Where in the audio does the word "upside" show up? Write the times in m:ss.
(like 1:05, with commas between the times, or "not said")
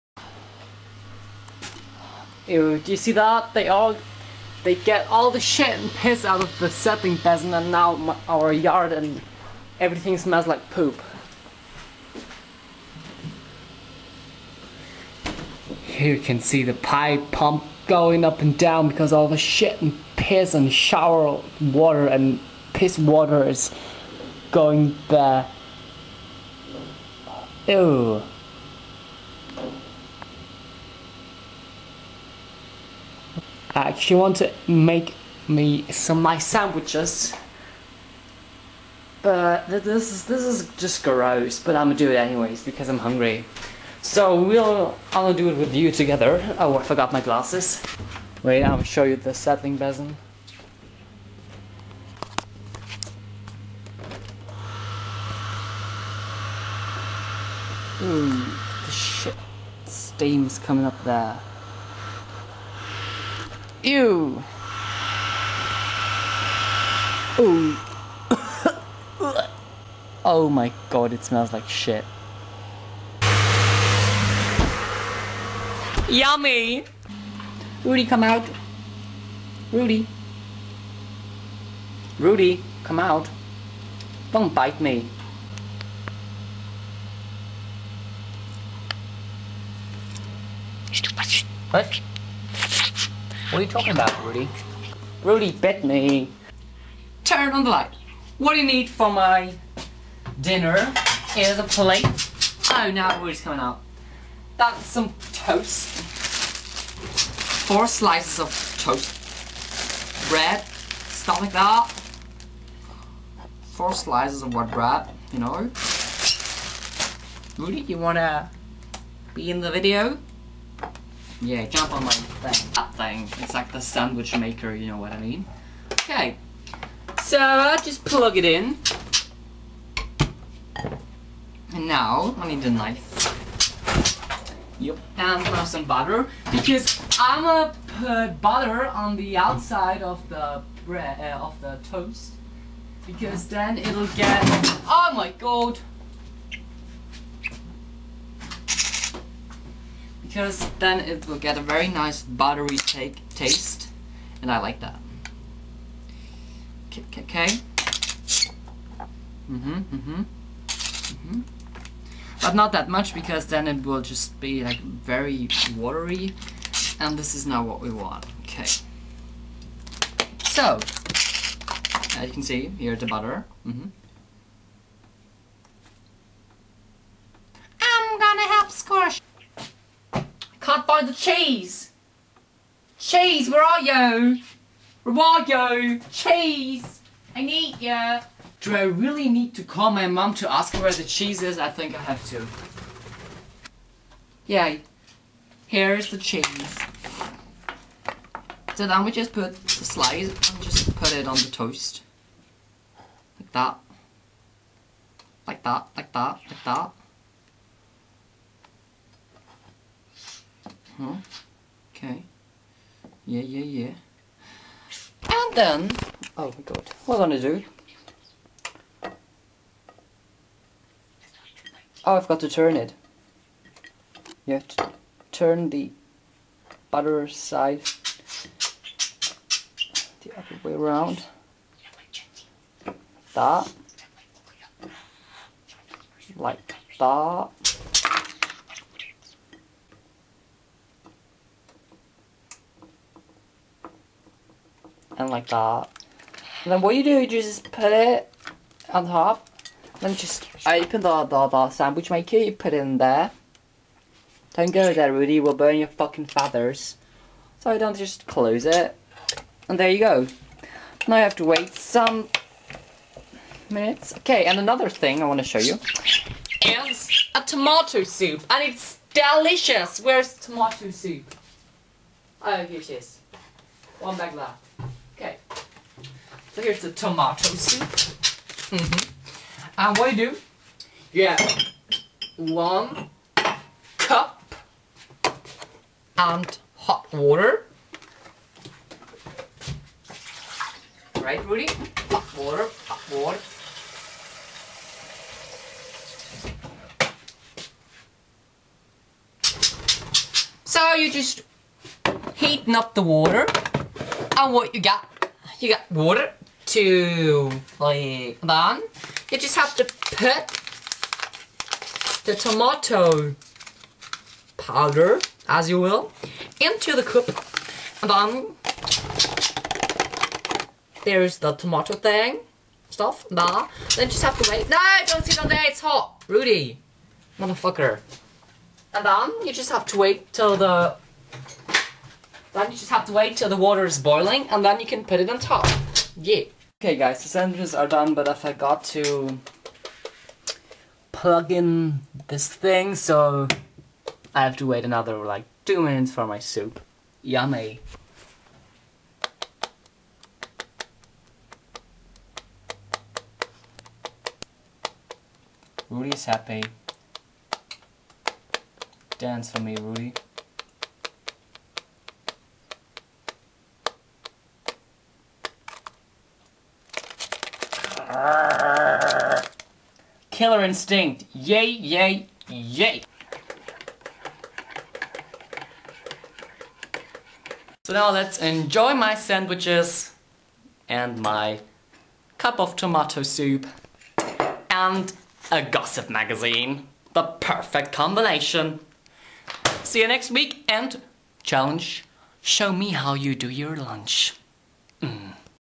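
not said.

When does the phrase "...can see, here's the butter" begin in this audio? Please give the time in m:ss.
2:52.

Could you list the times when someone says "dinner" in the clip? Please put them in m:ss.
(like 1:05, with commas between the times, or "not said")
1:40.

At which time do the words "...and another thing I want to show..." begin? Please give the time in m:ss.
4:24.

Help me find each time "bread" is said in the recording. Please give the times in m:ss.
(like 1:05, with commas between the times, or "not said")
1:50, 1:54, 2:20.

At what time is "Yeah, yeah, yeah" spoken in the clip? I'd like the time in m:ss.
3:33.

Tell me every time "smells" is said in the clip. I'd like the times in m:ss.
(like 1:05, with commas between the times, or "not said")
0:10, 1:11.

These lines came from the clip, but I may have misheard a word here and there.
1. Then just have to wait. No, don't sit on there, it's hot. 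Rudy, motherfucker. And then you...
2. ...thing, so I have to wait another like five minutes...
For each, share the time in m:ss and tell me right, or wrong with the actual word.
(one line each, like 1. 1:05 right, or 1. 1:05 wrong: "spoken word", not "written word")
1. 5:23 right
2. 5:42 wrong: "two", not "five".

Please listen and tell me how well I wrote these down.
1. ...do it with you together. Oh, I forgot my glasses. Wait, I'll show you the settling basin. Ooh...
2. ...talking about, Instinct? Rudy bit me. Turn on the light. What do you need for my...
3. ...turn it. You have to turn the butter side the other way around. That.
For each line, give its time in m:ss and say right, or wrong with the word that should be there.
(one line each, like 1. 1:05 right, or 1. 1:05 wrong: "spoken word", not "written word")
1. 0:45 right
2. 1:33 wrong: "Rudy", not "Instinct"
3. 3:42 right.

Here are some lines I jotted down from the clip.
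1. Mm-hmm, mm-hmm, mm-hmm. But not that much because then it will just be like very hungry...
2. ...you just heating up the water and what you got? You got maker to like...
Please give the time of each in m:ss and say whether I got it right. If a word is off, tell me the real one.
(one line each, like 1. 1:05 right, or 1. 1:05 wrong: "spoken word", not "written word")
1. 2:39 wrong: "watery", not "hungry"
2. 5:00 wrong: "water", not "maker".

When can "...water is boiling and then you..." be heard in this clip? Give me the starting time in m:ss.
5:33.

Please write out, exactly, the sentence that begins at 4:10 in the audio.
Then just open the, the, the sandwich maker, you put it in there.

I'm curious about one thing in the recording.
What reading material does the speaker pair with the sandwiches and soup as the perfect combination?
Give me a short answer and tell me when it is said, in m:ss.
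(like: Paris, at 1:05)
Gossip magazine, at 6:25.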